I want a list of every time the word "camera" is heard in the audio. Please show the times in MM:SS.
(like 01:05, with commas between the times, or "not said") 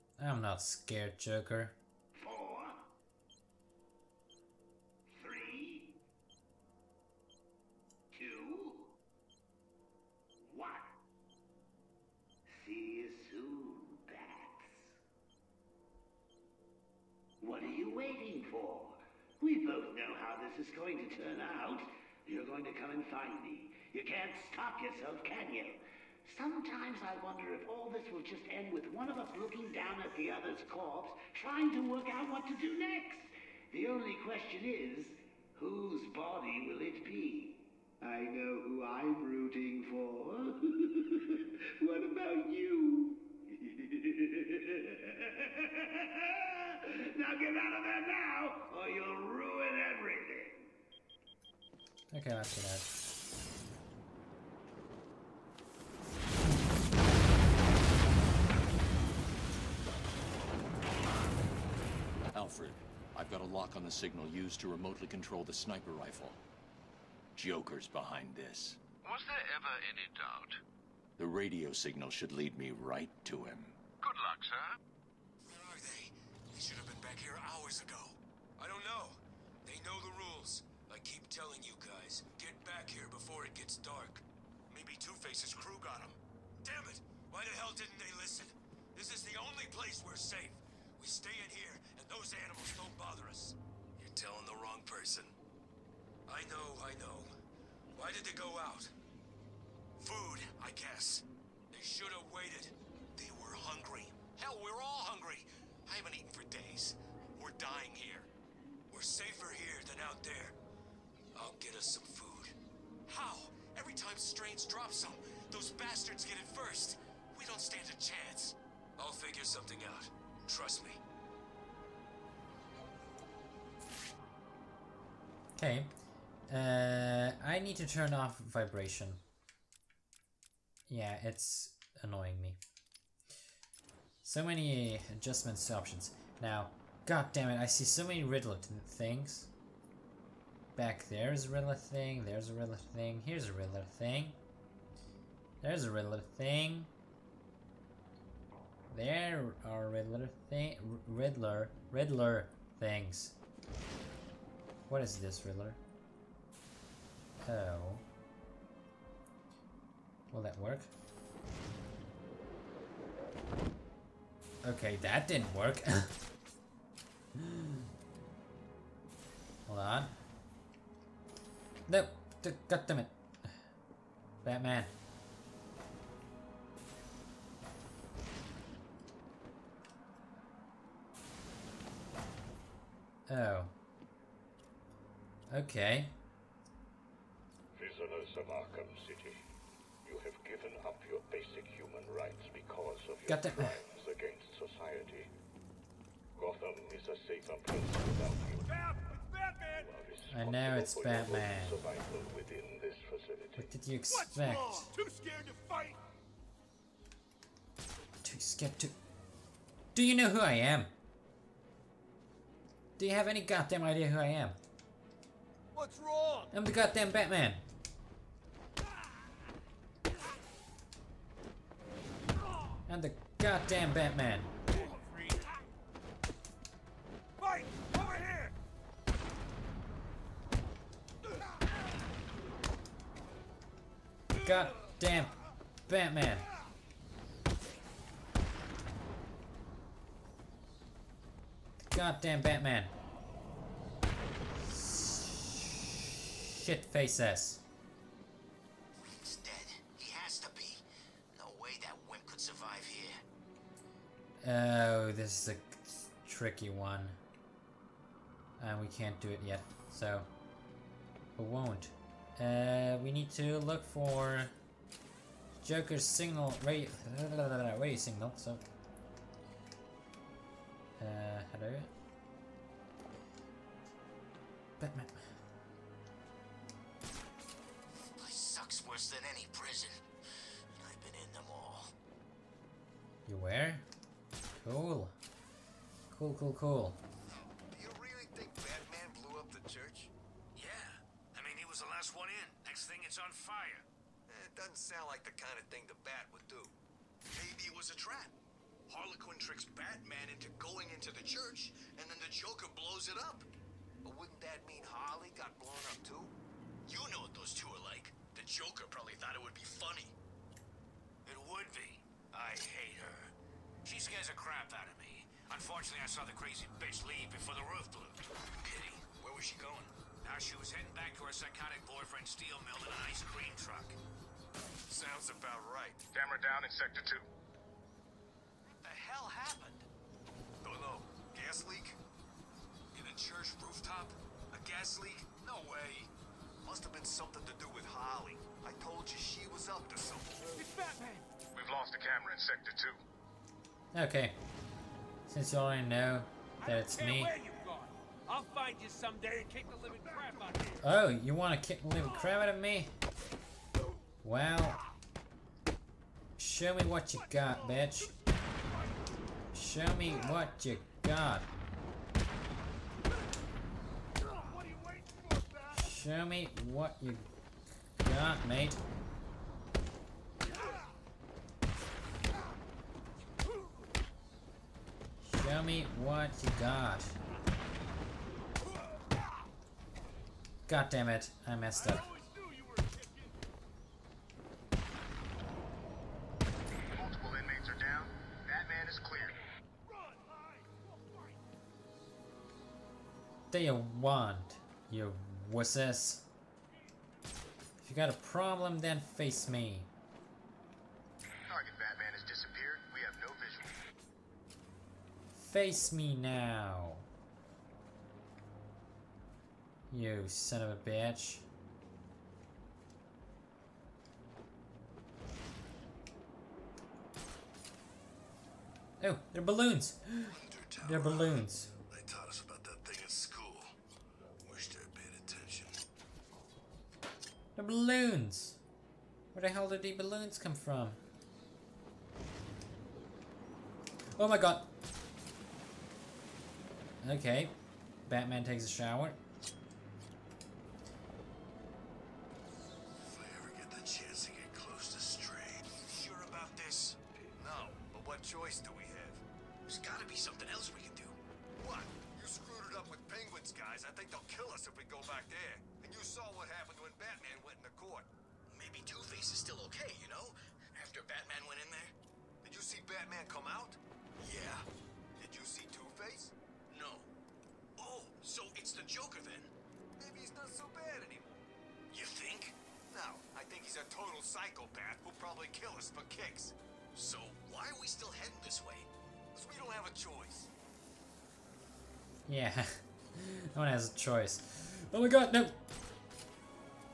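05:26, 05:41.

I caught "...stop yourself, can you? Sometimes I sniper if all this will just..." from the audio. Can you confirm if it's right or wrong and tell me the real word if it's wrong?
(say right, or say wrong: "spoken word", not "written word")
wrong: "wonder", not "sniper".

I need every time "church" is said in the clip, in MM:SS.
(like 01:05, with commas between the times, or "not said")
05:01, 05:33.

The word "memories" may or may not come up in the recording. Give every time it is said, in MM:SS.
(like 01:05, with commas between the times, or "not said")
not said.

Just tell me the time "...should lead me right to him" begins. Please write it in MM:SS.
01:12.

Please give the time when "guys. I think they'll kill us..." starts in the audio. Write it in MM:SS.
07:33.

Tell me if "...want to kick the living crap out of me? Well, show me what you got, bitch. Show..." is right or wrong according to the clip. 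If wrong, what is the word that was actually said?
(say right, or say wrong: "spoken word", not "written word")
right.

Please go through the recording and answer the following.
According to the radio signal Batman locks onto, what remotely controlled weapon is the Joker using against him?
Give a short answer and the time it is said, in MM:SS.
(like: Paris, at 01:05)
Sniper rifle, at 01:05.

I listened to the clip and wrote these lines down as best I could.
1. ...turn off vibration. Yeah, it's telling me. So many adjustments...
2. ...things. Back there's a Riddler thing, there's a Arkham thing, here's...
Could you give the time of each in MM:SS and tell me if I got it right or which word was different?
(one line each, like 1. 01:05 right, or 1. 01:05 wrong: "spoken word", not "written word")
1. 02:07 wrong: "annoying", not "telling"
2. 02:18 wrong: "Riddler", not "Arkham".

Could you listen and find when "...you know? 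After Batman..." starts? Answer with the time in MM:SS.
07:40.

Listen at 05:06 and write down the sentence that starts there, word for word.
You know what those two are like.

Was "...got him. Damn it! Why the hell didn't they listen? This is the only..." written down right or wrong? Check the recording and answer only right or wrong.
right.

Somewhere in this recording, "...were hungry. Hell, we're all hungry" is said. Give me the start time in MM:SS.
01:43.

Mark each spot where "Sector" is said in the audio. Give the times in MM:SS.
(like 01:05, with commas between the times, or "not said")
05:26, 05:42.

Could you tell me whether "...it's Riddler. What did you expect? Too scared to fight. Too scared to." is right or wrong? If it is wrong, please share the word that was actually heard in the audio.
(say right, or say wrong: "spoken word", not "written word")
wrong: "Batman", not "Riddler".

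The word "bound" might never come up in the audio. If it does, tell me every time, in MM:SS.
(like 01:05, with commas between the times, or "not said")
not said.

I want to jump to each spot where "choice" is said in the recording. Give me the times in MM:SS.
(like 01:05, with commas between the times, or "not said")
07:59, 08:03.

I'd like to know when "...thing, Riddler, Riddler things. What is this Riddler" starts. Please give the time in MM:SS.
02:30.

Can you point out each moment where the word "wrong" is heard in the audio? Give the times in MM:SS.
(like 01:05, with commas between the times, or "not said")
01:34, 03:36.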